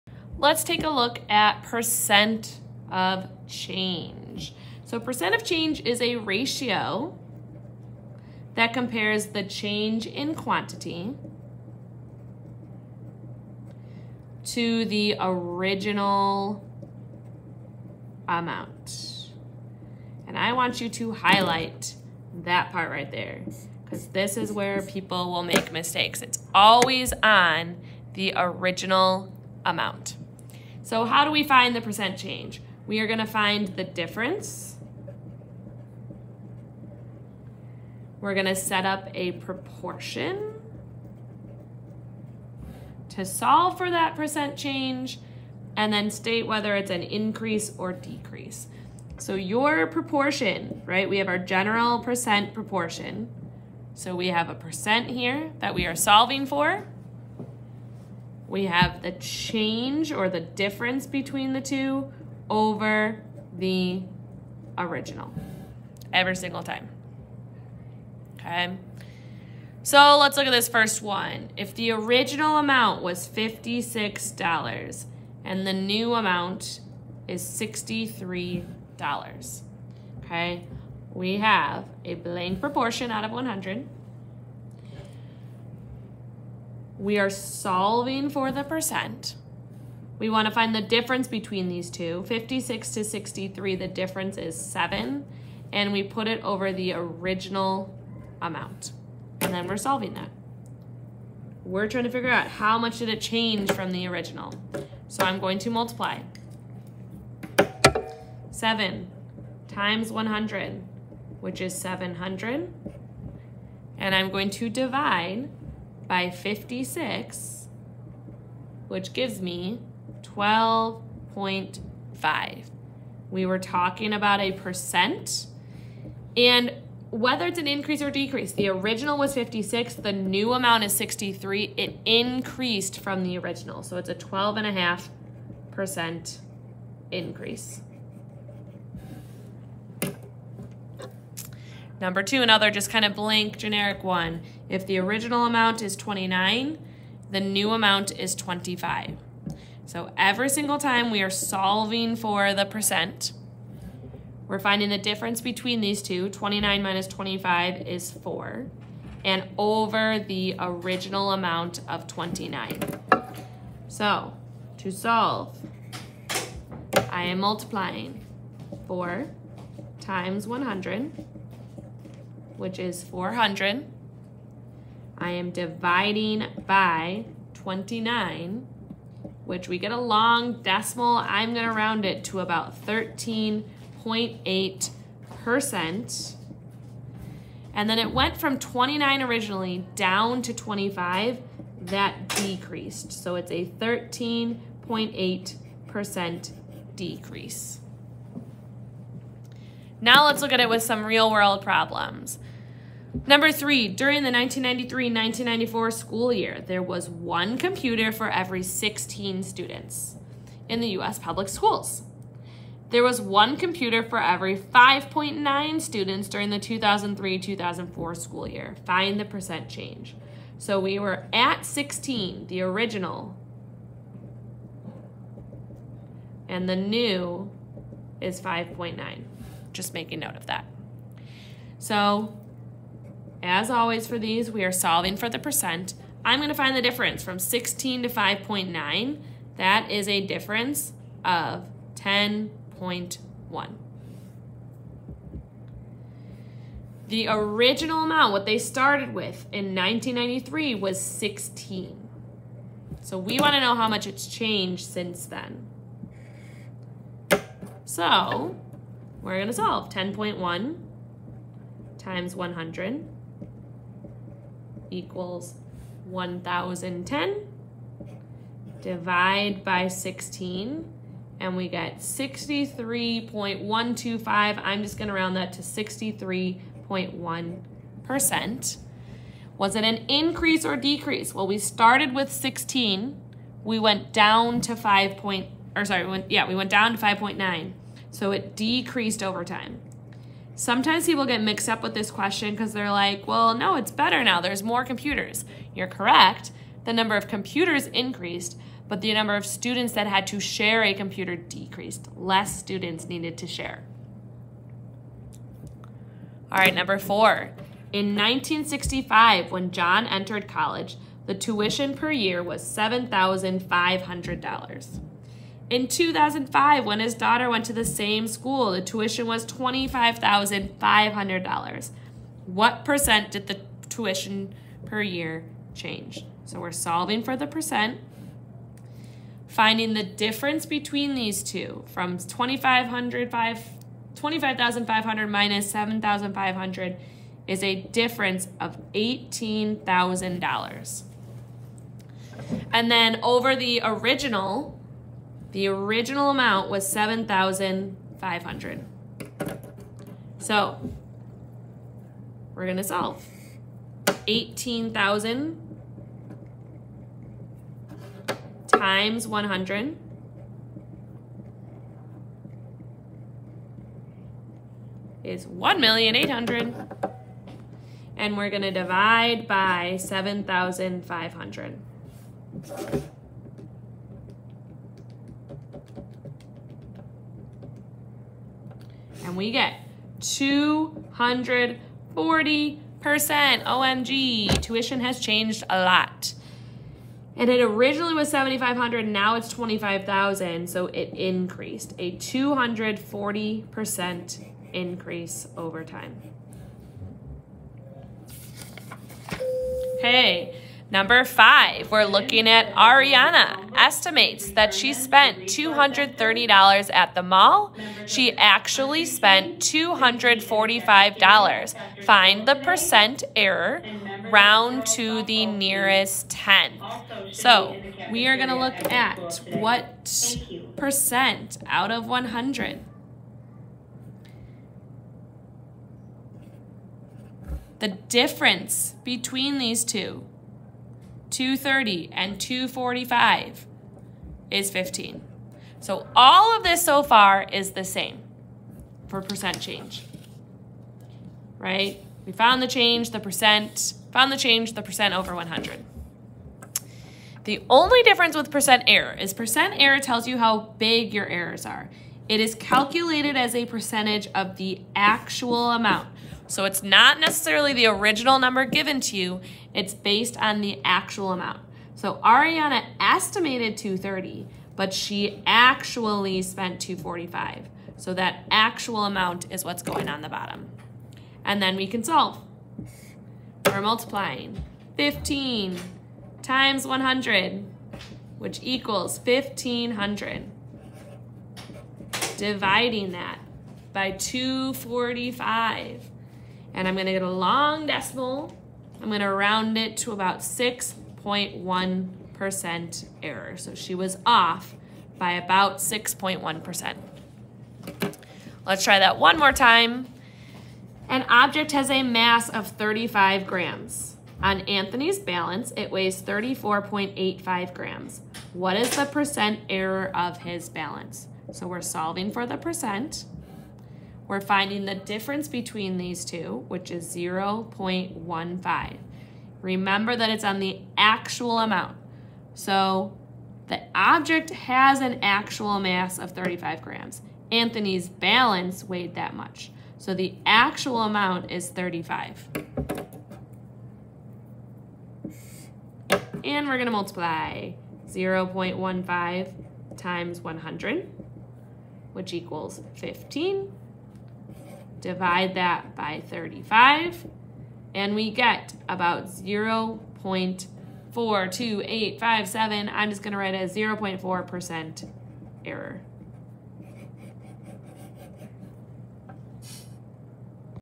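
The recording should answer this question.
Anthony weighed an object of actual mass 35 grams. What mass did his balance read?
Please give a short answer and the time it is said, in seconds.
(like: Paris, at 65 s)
34.85 grams, at 506 s.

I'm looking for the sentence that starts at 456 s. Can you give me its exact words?
So it's not necessarily the original number given to you, it's based on the actual amount.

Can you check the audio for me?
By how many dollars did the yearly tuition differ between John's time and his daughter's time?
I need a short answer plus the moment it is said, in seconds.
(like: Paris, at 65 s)
$18,000, at 338 s.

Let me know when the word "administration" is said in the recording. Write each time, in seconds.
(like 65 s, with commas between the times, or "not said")
not said.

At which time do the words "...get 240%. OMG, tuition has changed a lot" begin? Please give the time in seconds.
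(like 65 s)
379 s.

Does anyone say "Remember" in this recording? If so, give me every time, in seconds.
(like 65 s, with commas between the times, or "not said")
519 s.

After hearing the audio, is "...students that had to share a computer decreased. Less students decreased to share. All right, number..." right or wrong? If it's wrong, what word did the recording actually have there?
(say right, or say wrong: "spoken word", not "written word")
wrong: "needed", not "decreased".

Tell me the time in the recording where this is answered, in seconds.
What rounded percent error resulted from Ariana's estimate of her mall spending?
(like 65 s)
490 s.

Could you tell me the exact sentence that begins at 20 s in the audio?
And I want you to highlight that part right there because this is where people will make mistakes.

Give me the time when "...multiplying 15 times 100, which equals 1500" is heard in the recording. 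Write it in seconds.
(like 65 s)
473 s.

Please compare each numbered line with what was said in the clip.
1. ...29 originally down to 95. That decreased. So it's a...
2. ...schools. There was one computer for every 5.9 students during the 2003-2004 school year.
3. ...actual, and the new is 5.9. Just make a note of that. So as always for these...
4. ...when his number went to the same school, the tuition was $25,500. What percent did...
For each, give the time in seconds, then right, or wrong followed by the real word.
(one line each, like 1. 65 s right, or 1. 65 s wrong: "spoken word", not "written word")
1. 188 s wrong: "25", not "95"
2. 211 s right
3. 222 s wrong: "original", not "actual"
4. 316 s wrong: "daughter", not "number".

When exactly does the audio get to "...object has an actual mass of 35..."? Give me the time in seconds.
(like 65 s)
523 s.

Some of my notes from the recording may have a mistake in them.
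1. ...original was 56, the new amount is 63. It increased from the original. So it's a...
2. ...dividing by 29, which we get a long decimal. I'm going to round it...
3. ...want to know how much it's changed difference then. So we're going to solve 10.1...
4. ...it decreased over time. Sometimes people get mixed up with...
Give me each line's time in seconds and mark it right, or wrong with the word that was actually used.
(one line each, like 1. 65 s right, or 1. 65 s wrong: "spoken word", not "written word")
1. 128 s right
2. 175 s right
3. 253 s wrong: "since", not "difference"
4. 288 s right.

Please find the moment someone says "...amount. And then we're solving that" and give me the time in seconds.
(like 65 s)
98 s.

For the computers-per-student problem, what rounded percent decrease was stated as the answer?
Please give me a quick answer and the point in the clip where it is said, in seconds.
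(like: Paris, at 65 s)
63.1%, at 275 s.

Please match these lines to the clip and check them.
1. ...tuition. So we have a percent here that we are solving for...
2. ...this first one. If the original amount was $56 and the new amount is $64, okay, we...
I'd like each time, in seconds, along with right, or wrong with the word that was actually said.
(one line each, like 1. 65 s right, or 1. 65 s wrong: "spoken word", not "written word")
1. 52 s wrong: "proportion", not "tuition"
2. 70 s wrong: "63", not "64".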